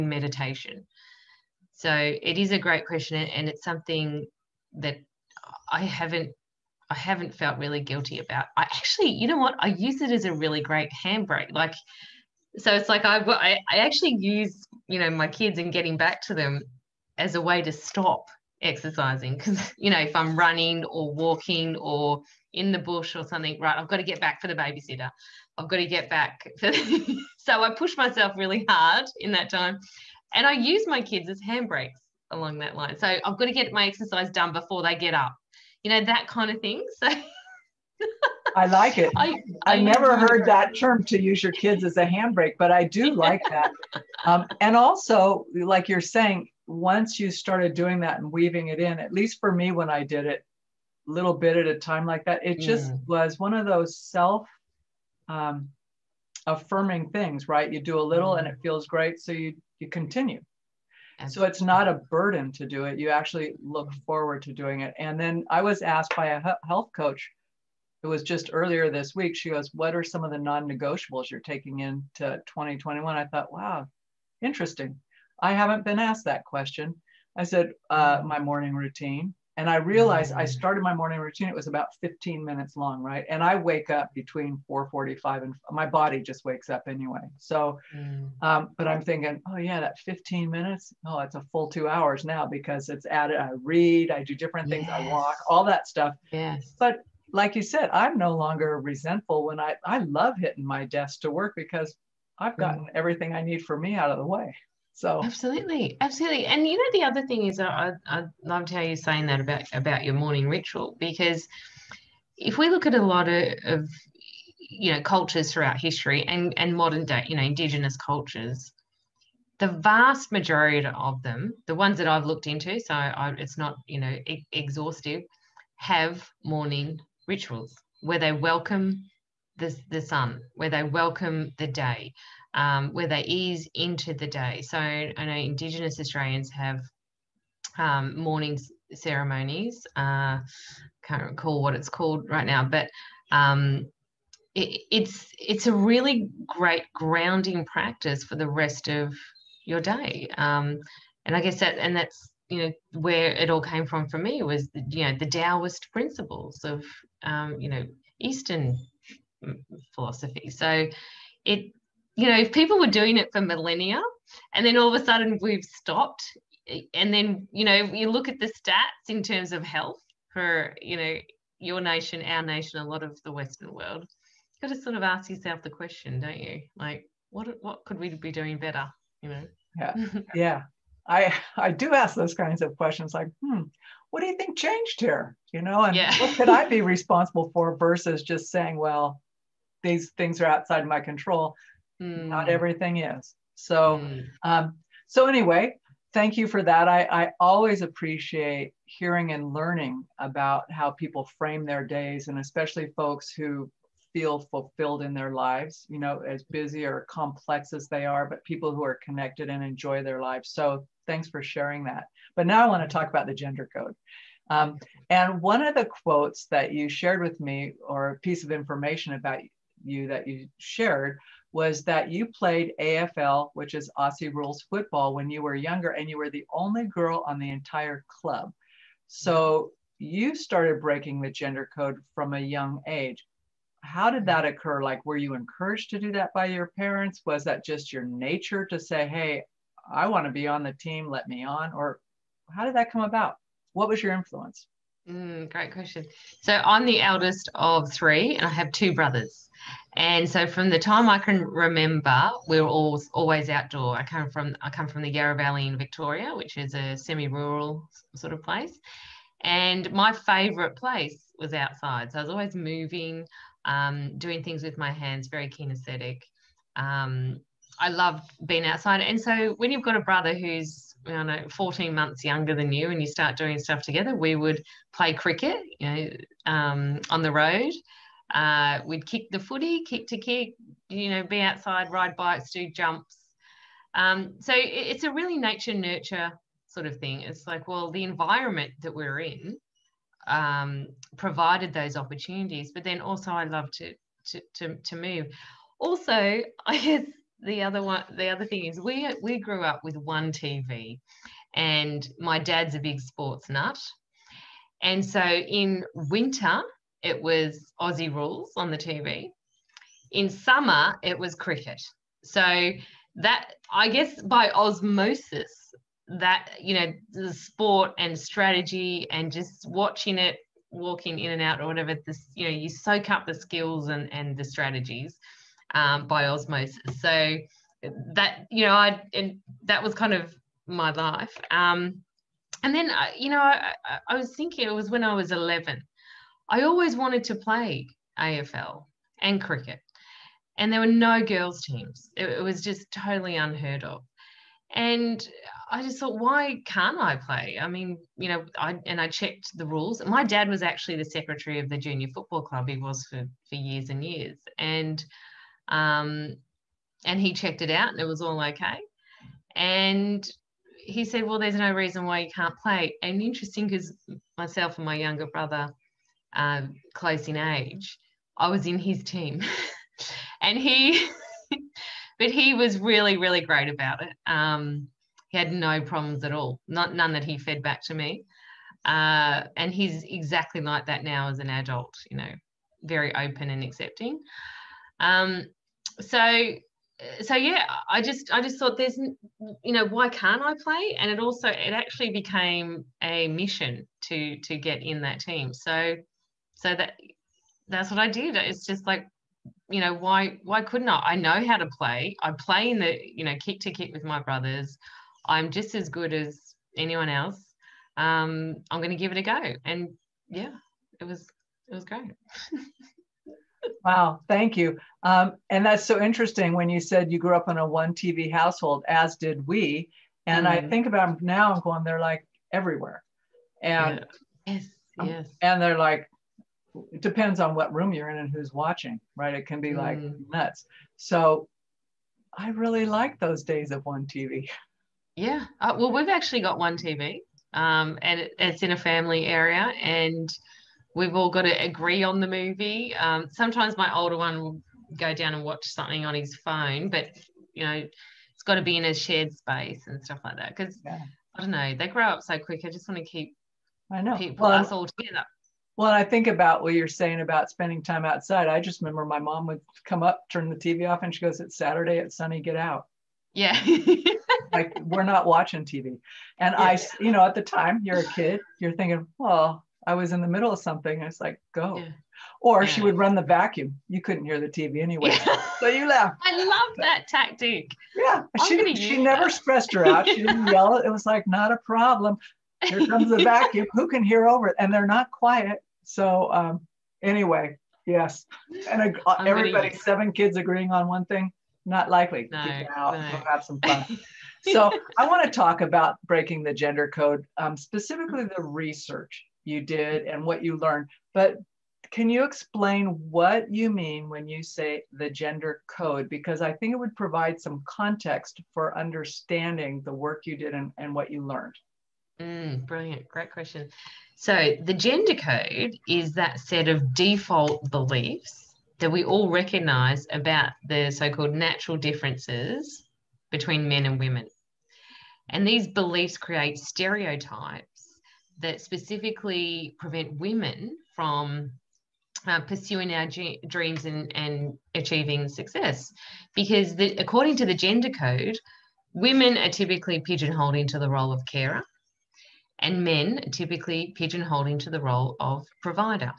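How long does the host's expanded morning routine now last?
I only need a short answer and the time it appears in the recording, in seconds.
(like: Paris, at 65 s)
2 hours, at 91 s.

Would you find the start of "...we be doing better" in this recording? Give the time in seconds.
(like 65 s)
177 s.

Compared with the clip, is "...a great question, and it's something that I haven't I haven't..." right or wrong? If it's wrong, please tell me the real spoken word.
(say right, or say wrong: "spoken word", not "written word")
right.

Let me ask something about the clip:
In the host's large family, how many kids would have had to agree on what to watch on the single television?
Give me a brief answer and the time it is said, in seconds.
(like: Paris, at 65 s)
7, at 489 s.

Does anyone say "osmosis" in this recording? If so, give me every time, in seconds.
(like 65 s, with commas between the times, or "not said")
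314 s, 326 s.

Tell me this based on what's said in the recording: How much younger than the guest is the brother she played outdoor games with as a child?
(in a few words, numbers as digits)
14 months.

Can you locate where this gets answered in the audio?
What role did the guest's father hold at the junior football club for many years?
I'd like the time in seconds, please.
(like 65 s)
351 s.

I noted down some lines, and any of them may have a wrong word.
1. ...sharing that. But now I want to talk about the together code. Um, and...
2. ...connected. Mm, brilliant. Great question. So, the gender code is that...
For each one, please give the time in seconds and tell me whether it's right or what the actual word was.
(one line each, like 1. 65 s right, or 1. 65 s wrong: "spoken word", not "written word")
1. 211 s wrong: "gender", not "together"
2. 511 s wrong: "learned", not "connected".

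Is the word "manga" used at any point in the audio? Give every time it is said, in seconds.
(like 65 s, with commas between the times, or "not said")
not said.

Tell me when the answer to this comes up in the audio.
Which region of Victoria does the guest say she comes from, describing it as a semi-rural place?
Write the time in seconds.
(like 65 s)
255 s.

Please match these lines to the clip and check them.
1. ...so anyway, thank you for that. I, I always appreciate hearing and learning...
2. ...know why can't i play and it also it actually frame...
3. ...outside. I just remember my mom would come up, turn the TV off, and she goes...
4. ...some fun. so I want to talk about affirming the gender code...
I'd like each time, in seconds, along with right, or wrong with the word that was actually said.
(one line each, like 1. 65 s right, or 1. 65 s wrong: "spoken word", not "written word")
1. 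195 s right
2. 389 s wrong: "became", not "frame"
3. 458 s right
4. 493 s wrong: "breaking", not "affirming".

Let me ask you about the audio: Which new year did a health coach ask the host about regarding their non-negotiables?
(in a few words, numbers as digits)
2021.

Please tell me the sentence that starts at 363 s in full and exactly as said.
And interesting because myself and my younger brother, uh, close in age, I was in his team.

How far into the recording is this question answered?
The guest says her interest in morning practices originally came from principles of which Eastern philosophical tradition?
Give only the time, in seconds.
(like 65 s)
155 s.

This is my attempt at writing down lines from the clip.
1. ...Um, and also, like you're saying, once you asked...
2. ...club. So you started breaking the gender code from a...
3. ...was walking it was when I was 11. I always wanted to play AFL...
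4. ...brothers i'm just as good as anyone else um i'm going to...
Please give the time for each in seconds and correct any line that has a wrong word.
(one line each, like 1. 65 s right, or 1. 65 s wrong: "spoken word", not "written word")
1. 44 s wrong: "started", not "asked"
2. 228 s right
3. 334 s wrong: "thinking", not "walking"
4. 404 s right.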